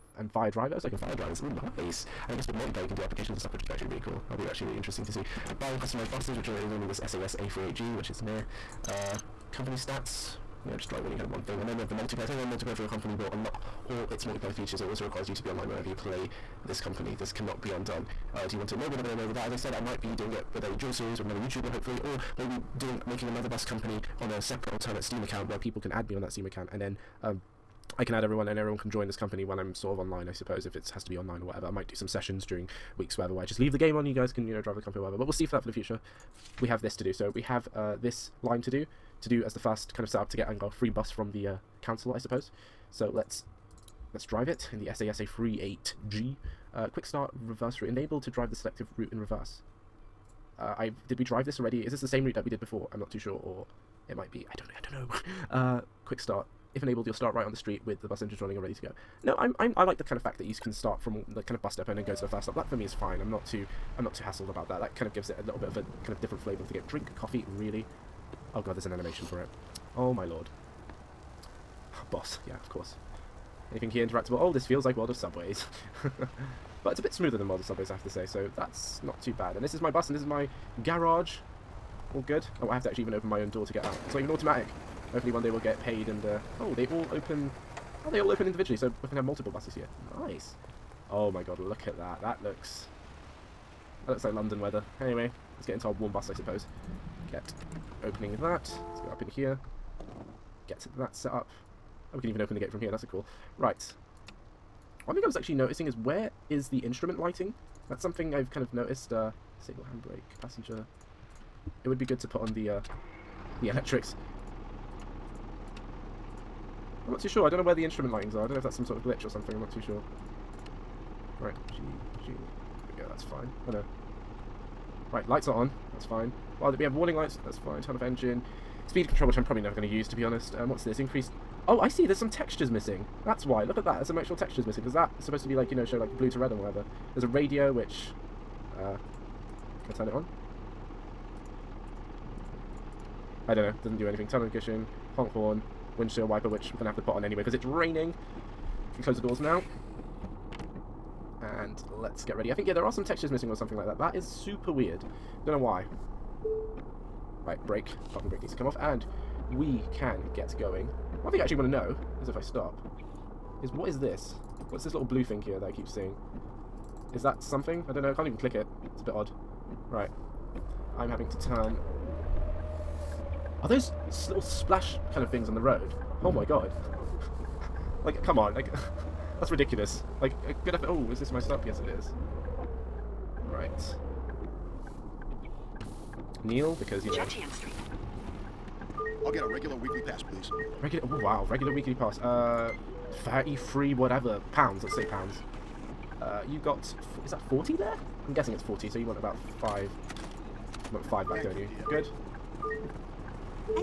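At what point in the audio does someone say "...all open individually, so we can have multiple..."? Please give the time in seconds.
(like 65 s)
88 s.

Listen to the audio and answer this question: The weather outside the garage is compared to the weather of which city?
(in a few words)
London.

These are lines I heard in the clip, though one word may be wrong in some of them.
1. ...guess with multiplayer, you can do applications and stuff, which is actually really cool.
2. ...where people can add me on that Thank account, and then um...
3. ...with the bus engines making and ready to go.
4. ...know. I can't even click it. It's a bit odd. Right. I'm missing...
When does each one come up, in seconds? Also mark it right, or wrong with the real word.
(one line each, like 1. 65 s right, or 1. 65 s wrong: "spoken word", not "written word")
1. 2 s right
2. 25 s wrong: "Steam", not "Thank"
3. 57 s wrong: "running", not "making"
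4. 168 s wrong: "having", not "missing".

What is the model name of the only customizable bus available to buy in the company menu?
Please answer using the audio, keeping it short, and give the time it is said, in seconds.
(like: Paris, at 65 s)
SAS A38G, at 7 s.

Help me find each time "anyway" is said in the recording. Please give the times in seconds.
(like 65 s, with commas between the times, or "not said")
95 s, 147 s.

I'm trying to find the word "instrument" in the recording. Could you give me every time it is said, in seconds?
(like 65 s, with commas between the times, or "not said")
106 s, 117 s.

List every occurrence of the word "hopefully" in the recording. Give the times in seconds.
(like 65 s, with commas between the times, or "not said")
21 s, 85 s.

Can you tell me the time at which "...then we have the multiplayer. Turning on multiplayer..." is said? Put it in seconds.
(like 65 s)
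11 s.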